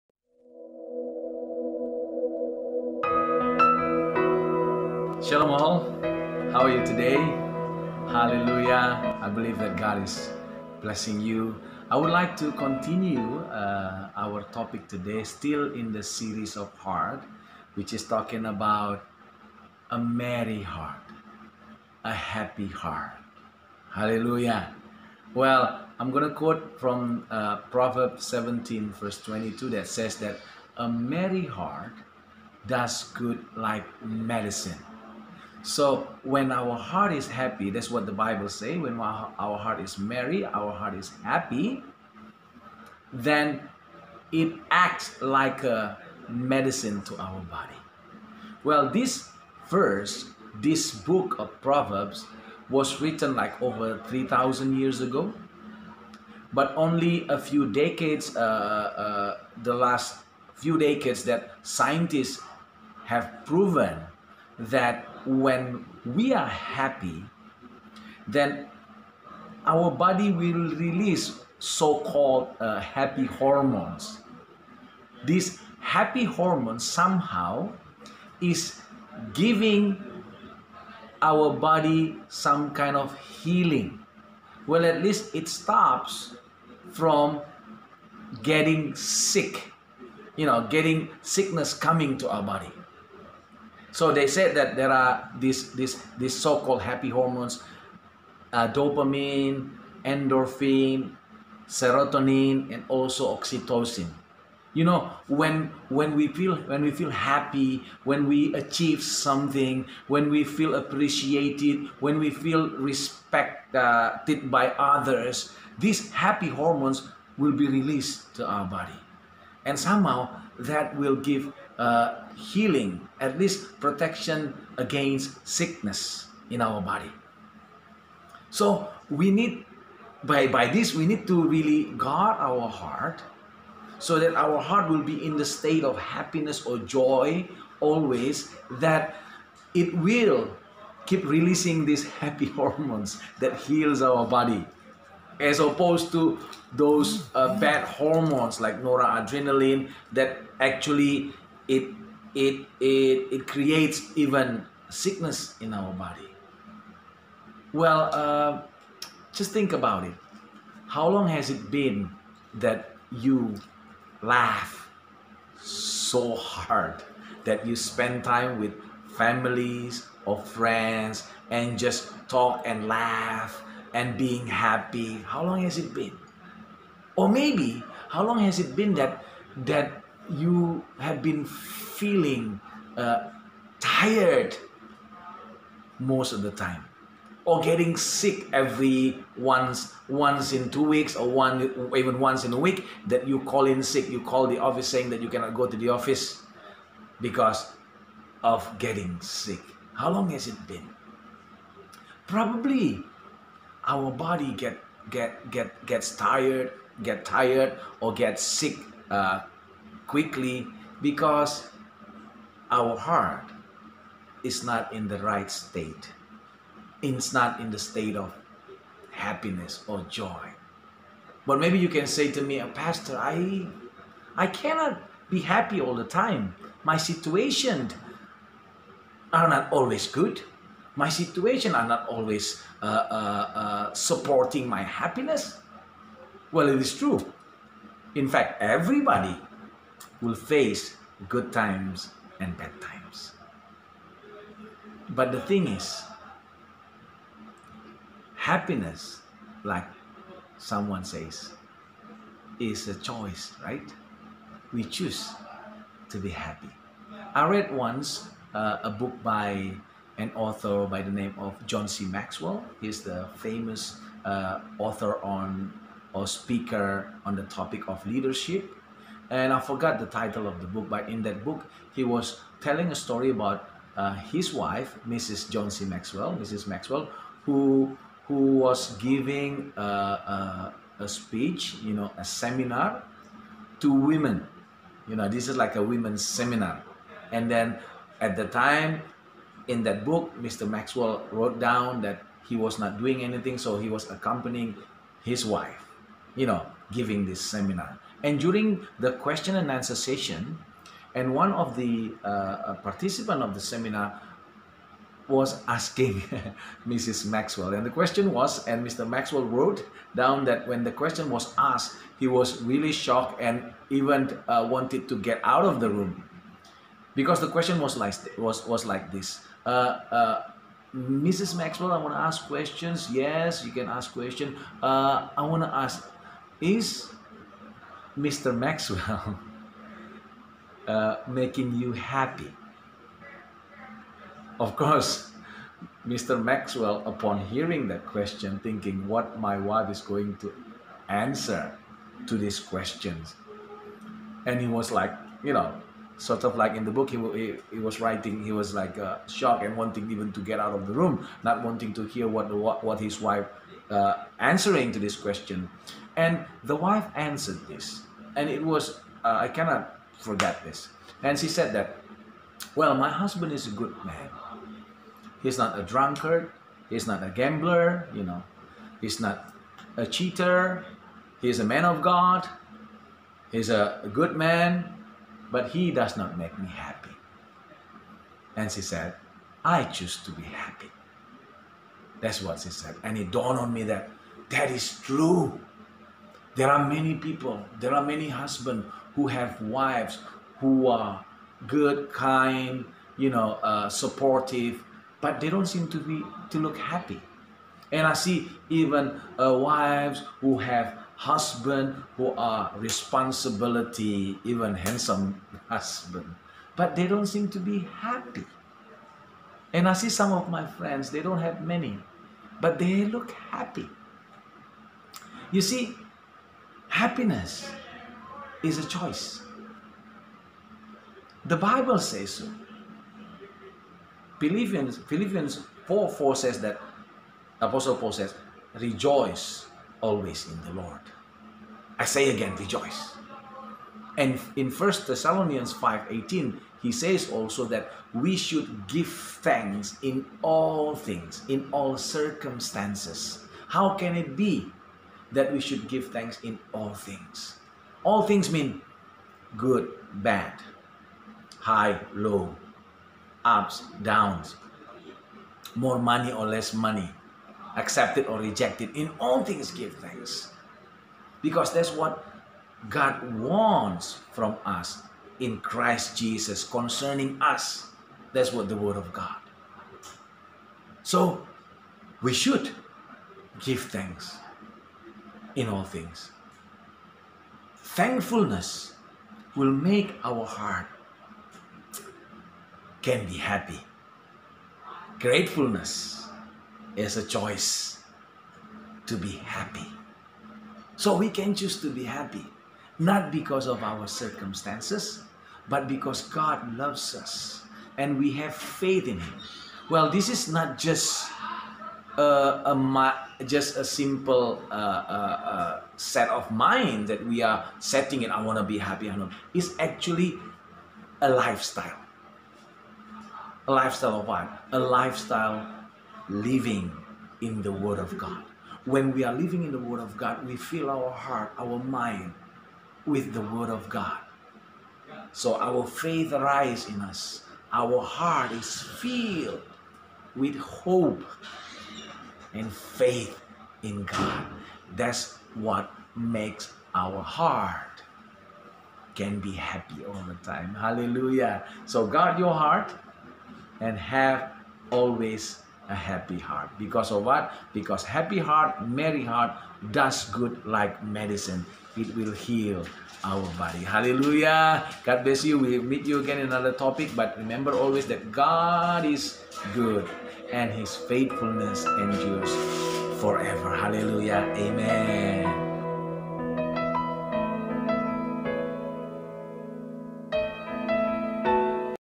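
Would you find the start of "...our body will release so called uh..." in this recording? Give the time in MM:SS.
01:09.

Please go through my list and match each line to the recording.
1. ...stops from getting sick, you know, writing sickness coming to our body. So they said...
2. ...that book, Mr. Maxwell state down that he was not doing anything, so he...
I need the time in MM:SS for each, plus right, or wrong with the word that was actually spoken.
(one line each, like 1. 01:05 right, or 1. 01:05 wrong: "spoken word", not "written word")
1. 01:25 wrong: "getting", not "writing"
2. 04:49 wrong: "wrote", not "state".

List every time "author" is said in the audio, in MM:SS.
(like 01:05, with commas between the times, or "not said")
04:20, 04:24.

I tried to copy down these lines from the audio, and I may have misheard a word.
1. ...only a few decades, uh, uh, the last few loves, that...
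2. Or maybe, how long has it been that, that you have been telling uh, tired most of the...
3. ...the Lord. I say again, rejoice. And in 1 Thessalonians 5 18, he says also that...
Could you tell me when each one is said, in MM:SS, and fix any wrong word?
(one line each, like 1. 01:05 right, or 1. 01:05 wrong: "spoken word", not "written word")
1. 00:56 wrong: "decades", not "loves"
2. 02:57 wrong: "feeling", not "telling"
3. 07:10 right.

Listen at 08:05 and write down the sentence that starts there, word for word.
Gratefulness is a choice to be happy.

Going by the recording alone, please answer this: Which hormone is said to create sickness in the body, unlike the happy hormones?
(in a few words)
noradrenaline.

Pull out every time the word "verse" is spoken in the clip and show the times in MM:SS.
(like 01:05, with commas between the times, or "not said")
00:28, 00:49.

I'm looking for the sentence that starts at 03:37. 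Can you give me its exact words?
It's not in the state of happiness or joy.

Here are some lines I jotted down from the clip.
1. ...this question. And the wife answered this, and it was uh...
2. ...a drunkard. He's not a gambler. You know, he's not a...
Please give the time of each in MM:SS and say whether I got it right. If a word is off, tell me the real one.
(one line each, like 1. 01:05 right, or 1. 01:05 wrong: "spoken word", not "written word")
1. 05:54 right
2. 06:05 right.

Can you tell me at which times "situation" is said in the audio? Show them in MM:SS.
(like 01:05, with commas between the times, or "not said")
03:46, 03:51.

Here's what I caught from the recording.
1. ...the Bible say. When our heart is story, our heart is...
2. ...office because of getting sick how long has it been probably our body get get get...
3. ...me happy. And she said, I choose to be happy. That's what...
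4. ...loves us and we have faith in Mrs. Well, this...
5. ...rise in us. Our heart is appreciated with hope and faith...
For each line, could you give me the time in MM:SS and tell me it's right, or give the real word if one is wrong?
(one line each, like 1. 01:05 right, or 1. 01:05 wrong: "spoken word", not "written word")
1. 00:38 wrong: "merry", not "story"
2. 03:15 right
3. 06:16 right
4. 08:16 wrong: "Him", not "Mrs"
5. 08:46 wrong: "filled", not "appreciated".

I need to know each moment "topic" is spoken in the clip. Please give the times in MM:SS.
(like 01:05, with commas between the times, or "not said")
00:14, 04:27, 09:16.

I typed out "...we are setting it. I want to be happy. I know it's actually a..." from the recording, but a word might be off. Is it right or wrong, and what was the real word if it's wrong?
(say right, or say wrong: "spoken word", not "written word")
right.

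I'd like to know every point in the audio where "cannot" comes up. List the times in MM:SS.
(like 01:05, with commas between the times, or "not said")
03:15, 03:44, 05:59.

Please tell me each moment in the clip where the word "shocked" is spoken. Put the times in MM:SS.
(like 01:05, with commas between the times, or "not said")
05:12, 05:49.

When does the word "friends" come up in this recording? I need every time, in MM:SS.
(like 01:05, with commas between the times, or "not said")
02:50, 06:50.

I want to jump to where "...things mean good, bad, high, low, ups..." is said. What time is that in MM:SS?
07:28.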